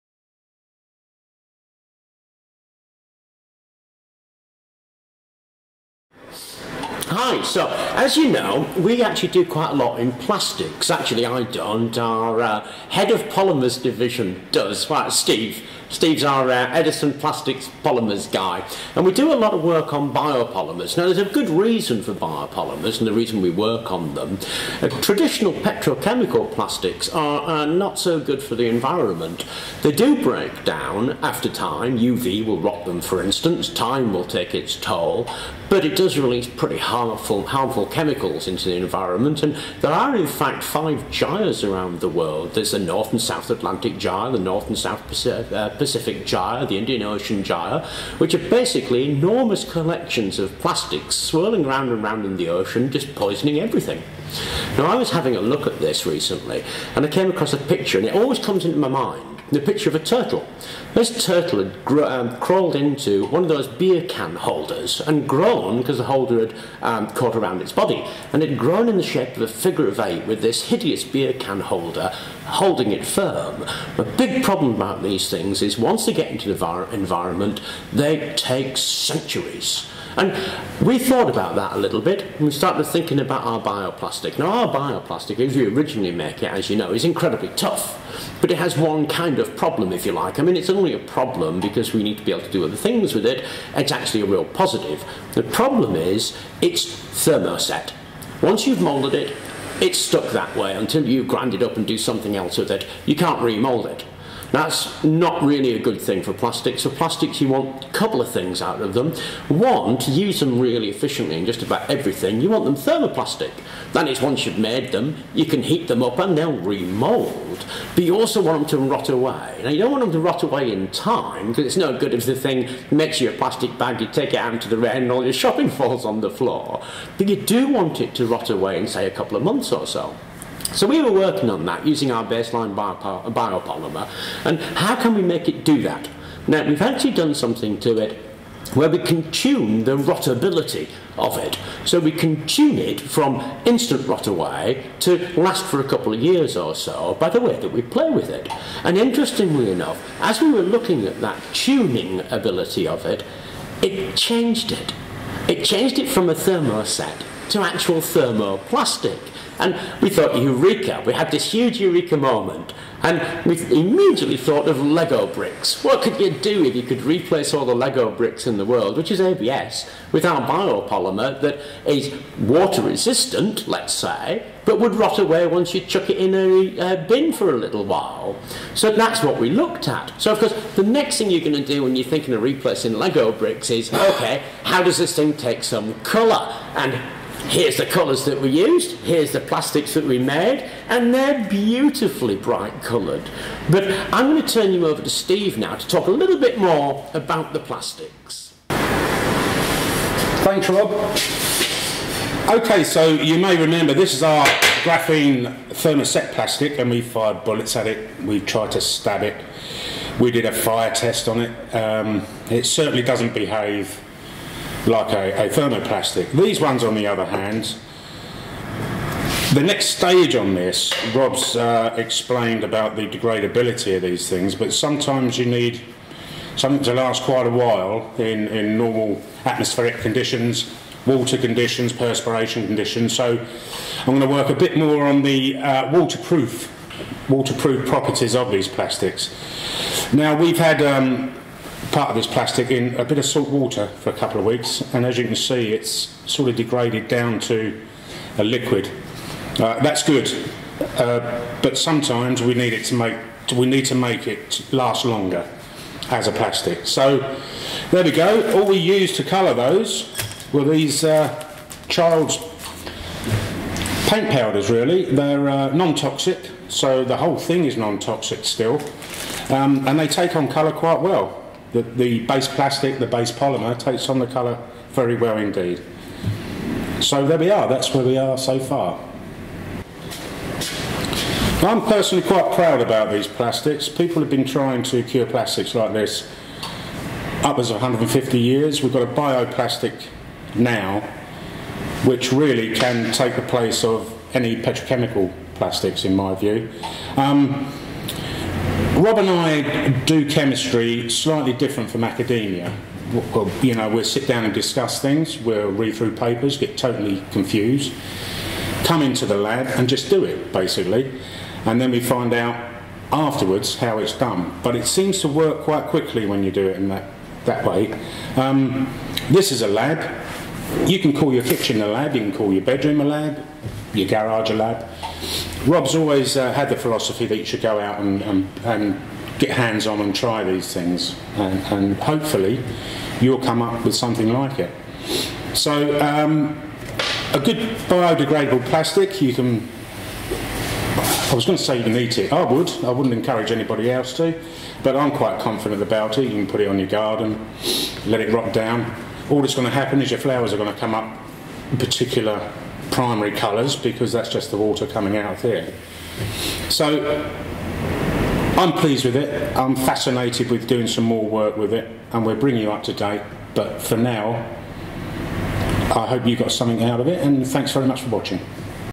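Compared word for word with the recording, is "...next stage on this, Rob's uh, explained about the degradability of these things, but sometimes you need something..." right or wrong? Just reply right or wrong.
right.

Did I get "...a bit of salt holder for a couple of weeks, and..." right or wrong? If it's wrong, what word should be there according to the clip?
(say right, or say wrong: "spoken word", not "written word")
wrong: "water", not "holder".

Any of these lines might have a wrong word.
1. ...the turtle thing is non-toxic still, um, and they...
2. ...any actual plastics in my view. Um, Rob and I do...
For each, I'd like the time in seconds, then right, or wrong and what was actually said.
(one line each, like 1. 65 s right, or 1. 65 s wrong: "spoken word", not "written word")
1. 267 s wrong: "whole", not "turtle"
2. 294 s wrong: "petrochemical", not "actual".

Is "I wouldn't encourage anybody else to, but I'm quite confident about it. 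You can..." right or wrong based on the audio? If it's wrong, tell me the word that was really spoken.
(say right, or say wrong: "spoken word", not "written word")
right.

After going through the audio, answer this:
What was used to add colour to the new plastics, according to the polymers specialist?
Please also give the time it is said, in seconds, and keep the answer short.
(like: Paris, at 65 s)
Child's paint powders, at 261 s.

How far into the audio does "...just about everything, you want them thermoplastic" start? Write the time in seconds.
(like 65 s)
111 s.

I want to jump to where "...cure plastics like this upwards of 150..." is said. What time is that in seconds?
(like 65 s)
285 s.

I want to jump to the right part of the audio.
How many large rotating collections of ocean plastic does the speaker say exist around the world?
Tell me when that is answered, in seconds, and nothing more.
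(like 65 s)
40 s.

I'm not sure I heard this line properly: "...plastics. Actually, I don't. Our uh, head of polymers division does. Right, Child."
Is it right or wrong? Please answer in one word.
wrong.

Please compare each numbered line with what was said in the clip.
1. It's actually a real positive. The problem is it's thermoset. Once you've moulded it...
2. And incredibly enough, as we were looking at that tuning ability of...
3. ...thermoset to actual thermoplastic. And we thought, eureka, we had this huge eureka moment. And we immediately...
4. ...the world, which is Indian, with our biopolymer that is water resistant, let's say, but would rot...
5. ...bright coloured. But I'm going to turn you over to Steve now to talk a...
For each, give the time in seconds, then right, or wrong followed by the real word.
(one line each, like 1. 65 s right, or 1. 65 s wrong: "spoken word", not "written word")
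1. 93 s right
2. 148 s wrong: "interestingly", not "incredibly"
3. 156 s right
4. 168 s wrong: "ABS", not "Indian"
5. 192 s right.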